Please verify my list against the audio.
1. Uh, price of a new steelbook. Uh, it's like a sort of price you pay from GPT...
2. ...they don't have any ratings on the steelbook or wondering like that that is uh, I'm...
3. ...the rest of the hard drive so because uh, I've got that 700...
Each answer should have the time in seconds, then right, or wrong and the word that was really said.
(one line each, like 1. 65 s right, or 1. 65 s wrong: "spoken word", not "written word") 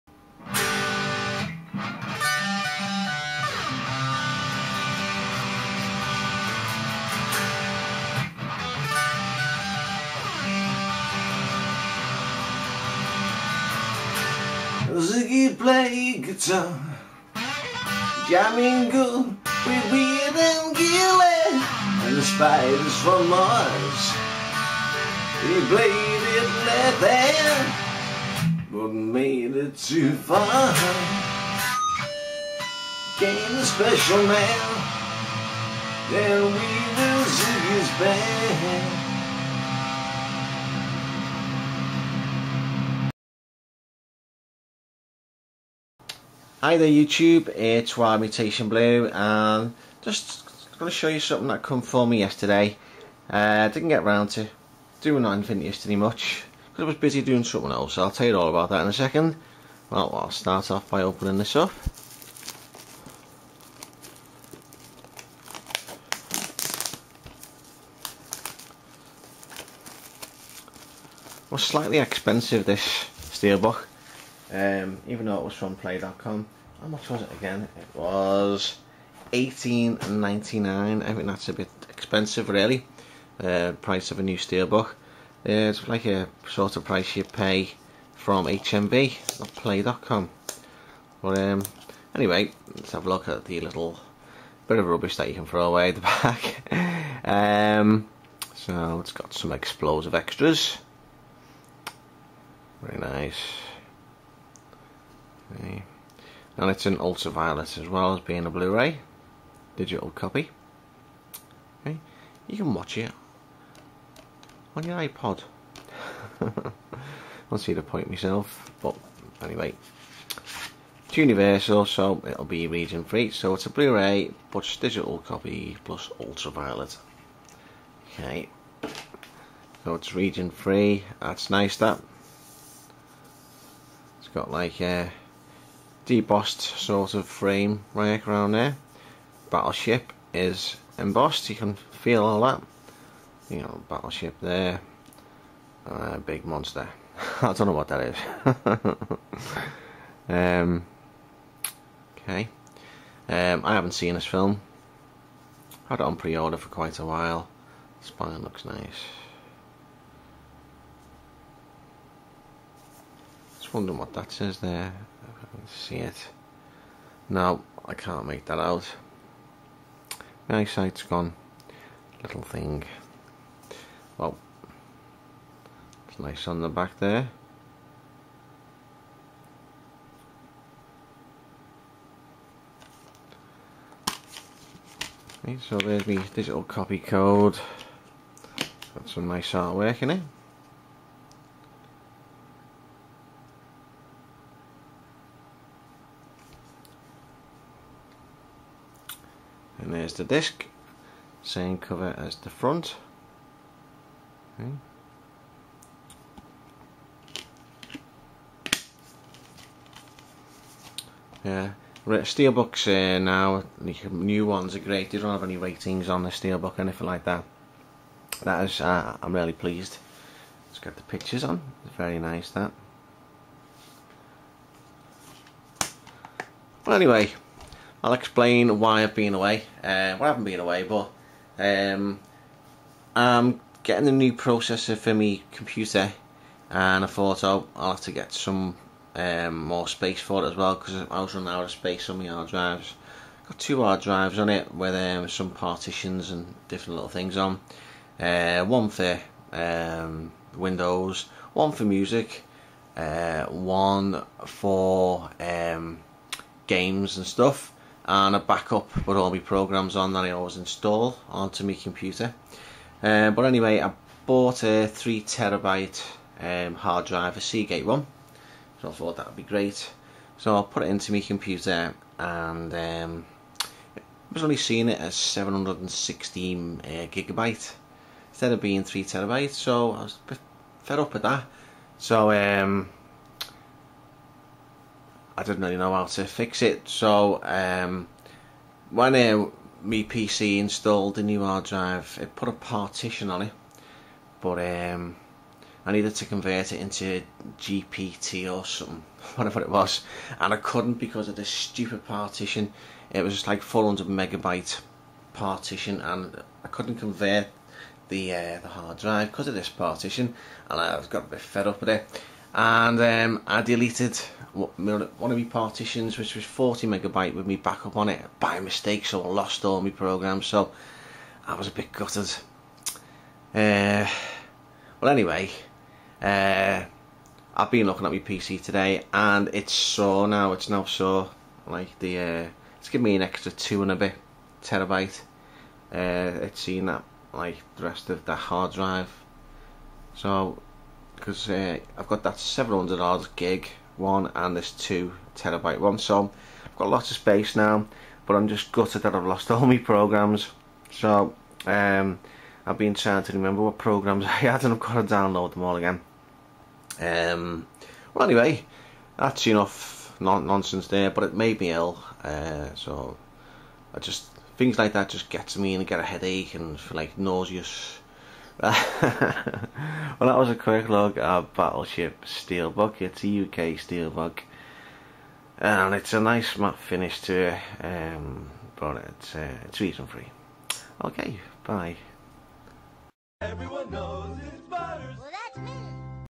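1. 83 s wrong: "HMV", not "GPT"
2. 215 s wrong: "anything", not "wondering"
3. 337 s right.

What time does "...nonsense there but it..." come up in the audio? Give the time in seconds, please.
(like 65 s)
360 s.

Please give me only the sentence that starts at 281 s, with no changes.
So um, I didn't really know how to fix it.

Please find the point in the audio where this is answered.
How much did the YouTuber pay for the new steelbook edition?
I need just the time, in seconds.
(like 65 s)
79 s.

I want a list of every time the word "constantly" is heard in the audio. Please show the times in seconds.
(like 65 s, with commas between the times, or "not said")
not said.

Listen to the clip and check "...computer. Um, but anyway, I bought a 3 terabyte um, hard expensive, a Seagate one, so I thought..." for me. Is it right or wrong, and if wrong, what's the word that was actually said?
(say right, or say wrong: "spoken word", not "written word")
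wrong: "drive", not "expensive".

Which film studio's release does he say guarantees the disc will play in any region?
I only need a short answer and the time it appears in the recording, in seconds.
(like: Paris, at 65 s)
Universal, at 121 s.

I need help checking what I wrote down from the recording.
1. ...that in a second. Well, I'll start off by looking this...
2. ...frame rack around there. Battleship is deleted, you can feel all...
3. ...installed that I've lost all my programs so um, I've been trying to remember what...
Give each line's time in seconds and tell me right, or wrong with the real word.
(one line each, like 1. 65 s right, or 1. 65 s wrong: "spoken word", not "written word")
1. 58 s wrong: "opening", not "looking"
2. 137 s wrong: "embossed", not "deleted"
3. 348 s wrong: "gutted", not "installed".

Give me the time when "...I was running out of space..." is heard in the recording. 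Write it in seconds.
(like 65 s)
241 s.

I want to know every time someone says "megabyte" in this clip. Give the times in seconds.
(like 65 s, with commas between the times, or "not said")
304 s, 316 s.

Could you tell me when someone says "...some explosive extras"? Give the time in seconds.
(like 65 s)
99 s.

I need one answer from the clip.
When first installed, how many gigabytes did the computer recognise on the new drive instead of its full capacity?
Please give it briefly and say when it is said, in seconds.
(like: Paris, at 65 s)
716, at 275 s.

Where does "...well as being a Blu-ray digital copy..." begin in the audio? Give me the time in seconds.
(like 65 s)
107 s.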